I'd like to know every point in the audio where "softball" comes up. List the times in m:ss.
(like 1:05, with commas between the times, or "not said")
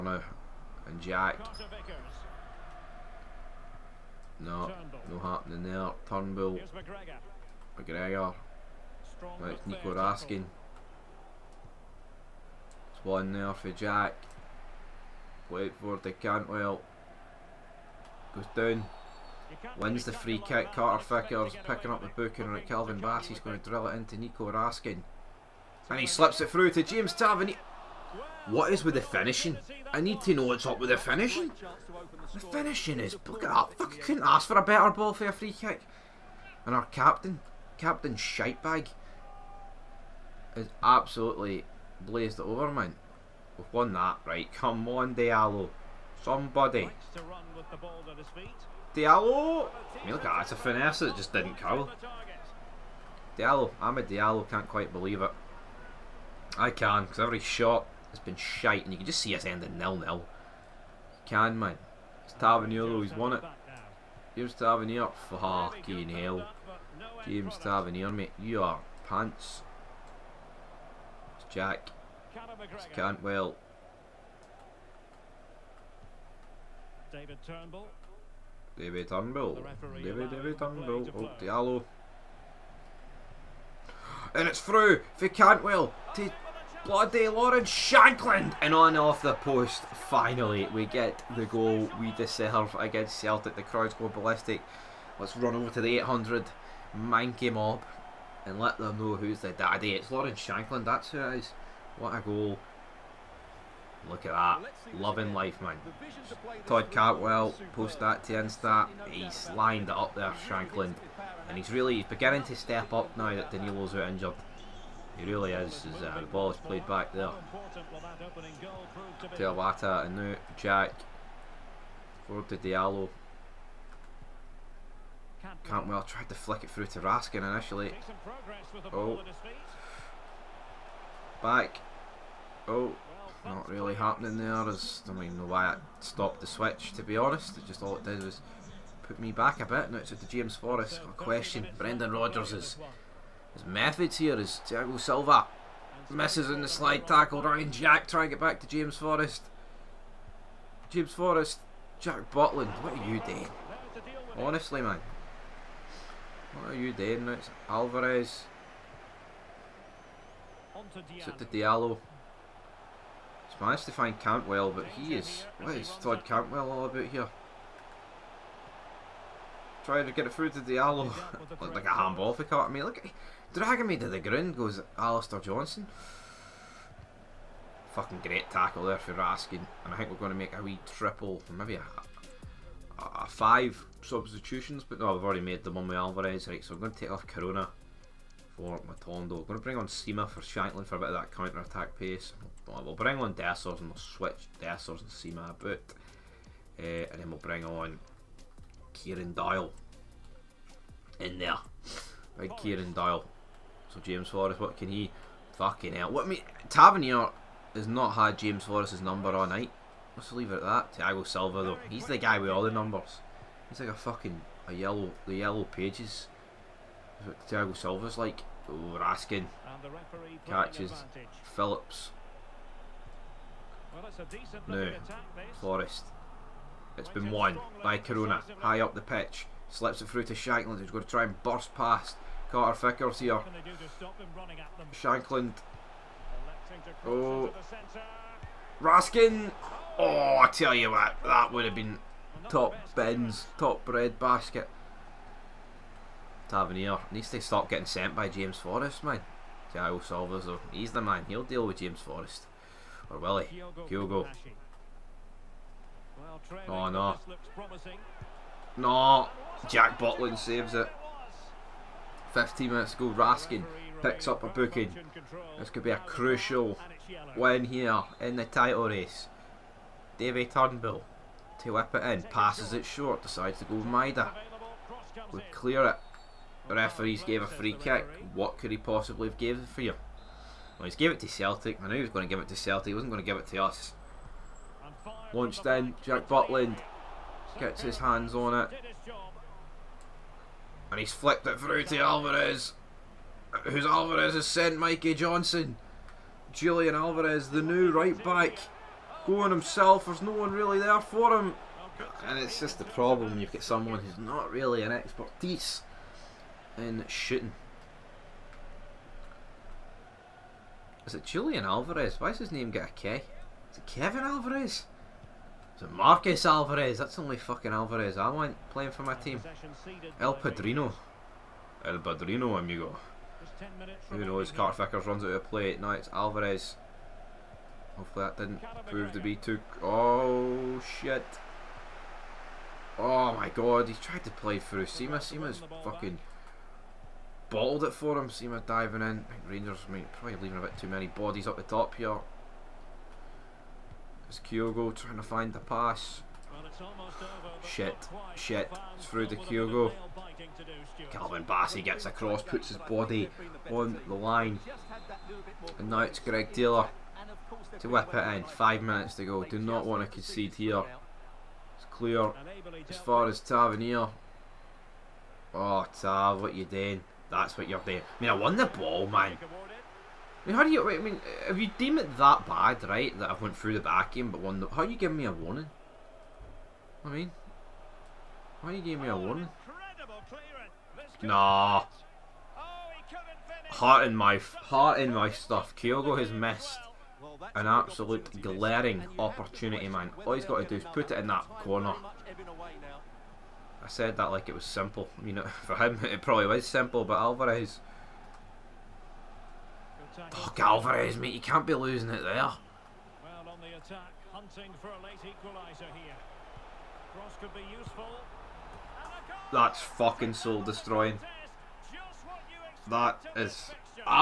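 not said.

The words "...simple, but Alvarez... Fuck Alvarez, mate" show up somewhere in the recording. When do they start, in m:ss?
6:36.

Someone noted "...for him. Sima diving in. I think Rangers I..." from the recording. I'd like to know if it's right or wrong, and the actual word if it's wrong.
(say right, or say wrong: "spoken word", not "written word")
right.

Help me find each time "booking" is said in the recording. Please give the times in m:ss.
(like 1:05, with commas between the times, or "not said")
0:22, 4:24.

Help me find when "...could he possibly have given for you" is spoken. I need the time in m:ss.
4:38.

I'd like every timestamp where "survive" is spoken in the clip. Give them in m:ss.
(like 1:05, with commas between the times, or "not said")
not said.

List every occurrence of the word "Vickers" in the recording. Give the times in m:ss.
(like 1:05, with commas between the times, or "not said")
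0:20, 3:52, 5:24.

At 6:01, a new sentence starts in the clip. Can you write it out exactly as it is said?
It's clear as far as Tavernier.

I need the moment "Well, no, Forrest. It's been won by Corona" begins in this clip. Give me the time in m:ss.
3:43.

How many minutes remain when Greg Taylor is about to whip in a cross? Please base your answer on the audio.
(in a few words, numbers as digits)
5.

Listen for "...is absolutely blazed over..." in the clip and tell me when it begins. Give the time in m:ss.
0:40.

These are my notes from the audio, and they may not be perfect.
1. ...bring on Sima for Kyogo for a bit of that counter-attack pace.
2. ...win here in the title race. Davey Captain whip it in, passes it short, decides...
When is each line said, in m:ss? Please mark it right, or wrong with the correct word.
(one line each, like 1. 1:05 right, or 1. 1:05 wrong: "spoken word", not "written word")
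1. 3:09 wrong: "Shankland", not "Kyogo"
2. 4:27 wrong: "Turnbull", not "Captain".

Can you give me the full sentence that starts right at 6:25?
Kyogo has missed an absolute glaring opportunity, man.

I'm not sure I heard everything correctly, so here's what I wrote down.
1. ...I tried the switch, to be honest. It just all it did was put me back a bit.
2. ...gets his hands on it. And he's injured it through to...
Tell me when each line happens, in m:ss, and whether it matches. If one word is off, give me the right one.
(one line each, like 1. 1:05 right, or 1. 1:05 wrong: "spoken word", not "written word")
1. 2:15 wrong: "stopped", not "tried"
2. 4:47 wrong: "flicked", not "injured".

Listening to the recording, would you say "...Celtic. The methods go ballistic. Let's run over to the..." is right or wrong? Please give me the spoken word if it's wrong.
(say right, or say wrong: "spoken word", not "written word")
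wrong: "crowds", not "methods".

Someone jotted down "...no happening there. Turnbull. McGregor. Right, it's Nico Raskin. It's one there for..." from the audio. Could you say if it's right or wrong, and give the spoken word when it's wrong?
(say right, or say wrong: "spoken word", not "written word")
right.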